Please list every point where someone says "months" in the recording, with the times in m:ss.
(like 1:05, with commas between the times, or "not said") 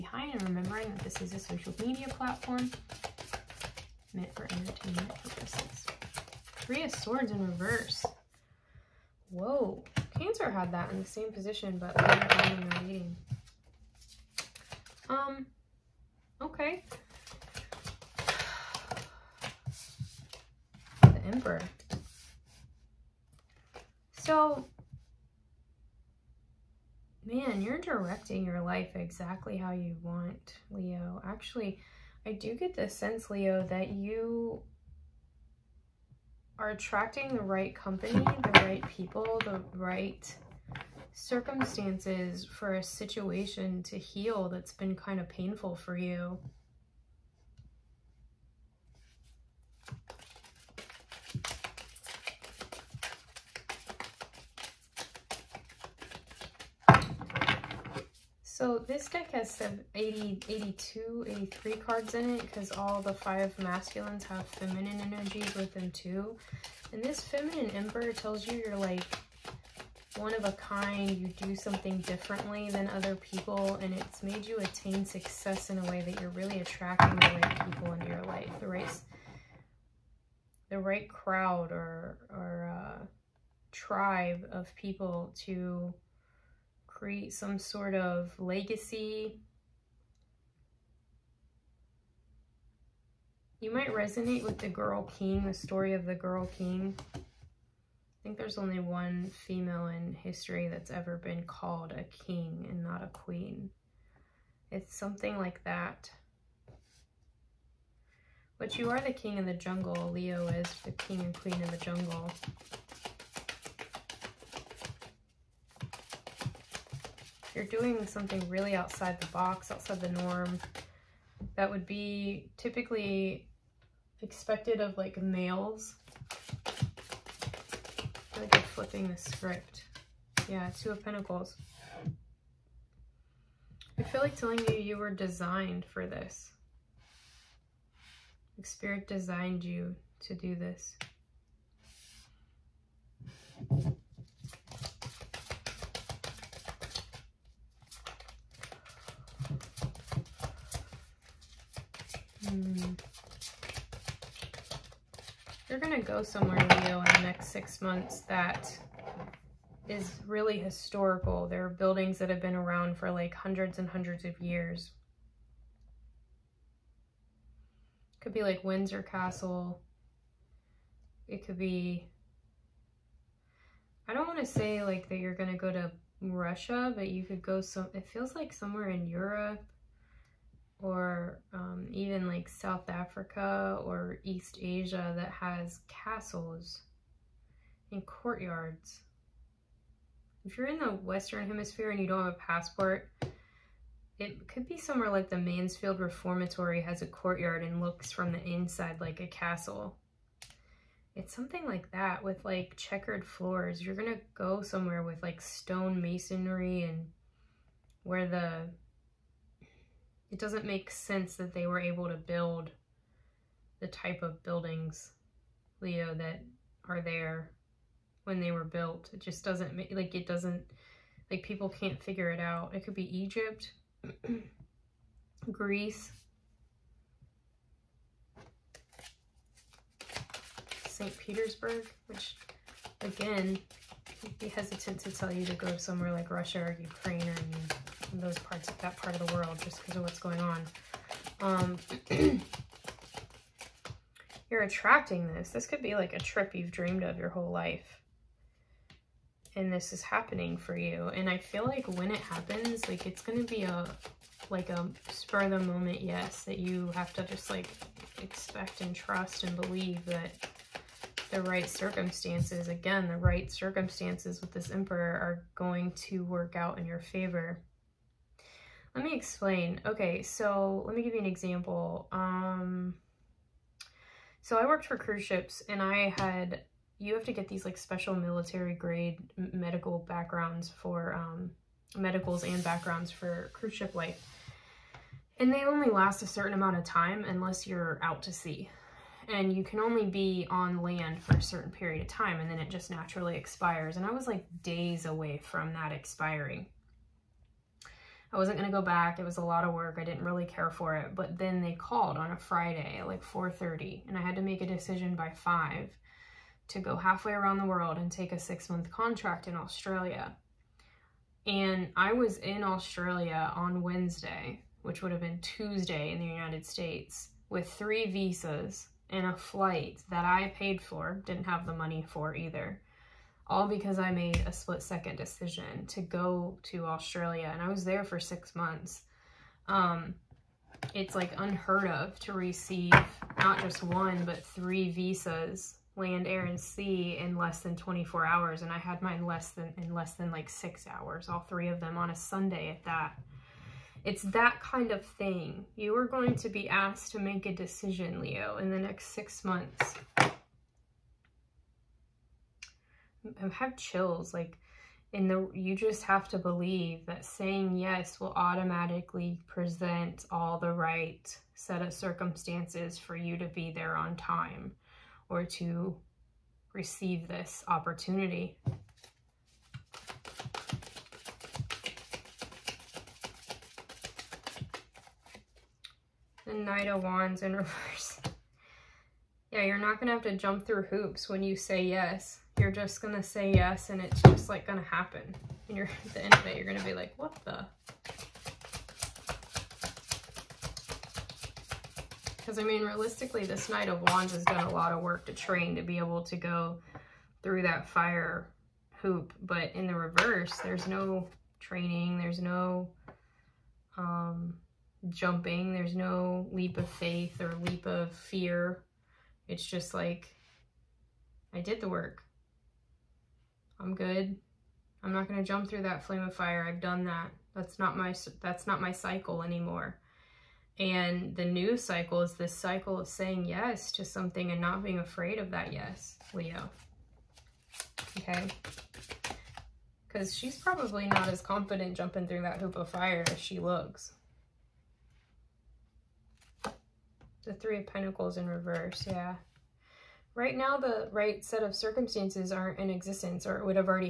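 2:37, 5:08, 5:28, 5:49.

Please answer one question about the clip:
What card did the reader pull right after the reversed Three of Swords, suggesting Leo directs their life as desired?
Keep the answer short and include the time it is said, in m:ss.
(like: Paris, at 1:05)
The Emperor, at 0:21.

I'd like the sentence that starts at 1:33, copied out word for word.
You might resonate with the Girl King, the story of the Girl King.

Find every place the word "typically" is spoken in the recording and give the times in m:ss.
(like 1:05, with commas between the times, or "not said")
2:02.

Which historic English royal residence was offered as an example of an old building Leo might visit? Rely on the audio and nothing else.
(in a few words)
Windsor Castle.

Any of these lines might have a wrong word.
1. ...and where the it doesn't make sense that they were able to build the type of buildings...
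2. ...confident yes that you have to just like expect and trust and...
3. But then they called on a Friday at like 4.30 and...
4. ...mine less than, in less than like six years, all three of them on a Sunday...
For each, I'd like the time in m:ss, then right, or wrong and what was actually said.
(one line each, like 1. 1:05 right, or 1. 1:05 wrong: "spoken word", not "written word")
1. 3:26 right
2. 4:15 wrong: "moment", not "confident"
3. 5:01 right
4. 5:39 wrong: "hours", not "years".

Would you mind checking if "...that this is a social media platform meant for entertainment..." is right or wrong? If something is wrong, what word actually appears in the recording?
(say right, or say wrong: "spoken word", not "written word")
right.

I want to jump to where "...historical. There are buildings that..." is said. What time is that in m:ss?
2:40.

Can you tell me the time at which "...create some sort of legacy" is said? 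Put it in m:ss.
1:26.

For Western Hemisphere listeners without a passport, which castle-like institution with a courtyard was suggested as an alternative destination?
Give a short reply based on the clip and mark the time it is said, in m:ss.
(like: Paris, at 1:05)
Mansfield Reformatory, at 3:15.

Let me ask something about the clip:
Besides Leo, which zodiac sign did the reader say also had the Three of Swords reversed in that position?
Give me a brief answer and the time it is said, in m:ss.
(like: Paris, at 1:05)
Cancer, at 0:10.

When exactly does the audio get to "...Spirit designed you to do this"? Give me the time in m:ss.
2:18.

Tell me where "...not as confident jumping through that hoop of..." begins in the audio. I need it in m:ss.
7:11.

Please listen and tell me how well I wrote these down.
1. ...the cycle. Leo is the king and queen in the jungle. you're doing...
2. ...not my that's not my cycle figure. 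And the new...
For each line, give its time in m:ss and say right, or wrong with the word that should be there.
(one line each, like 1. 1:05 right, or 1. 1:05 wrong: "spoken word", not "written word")
1. 1:49 wrong: "jungle", not "cycle"
2. 6:57 wrong: "anymore", not "figure".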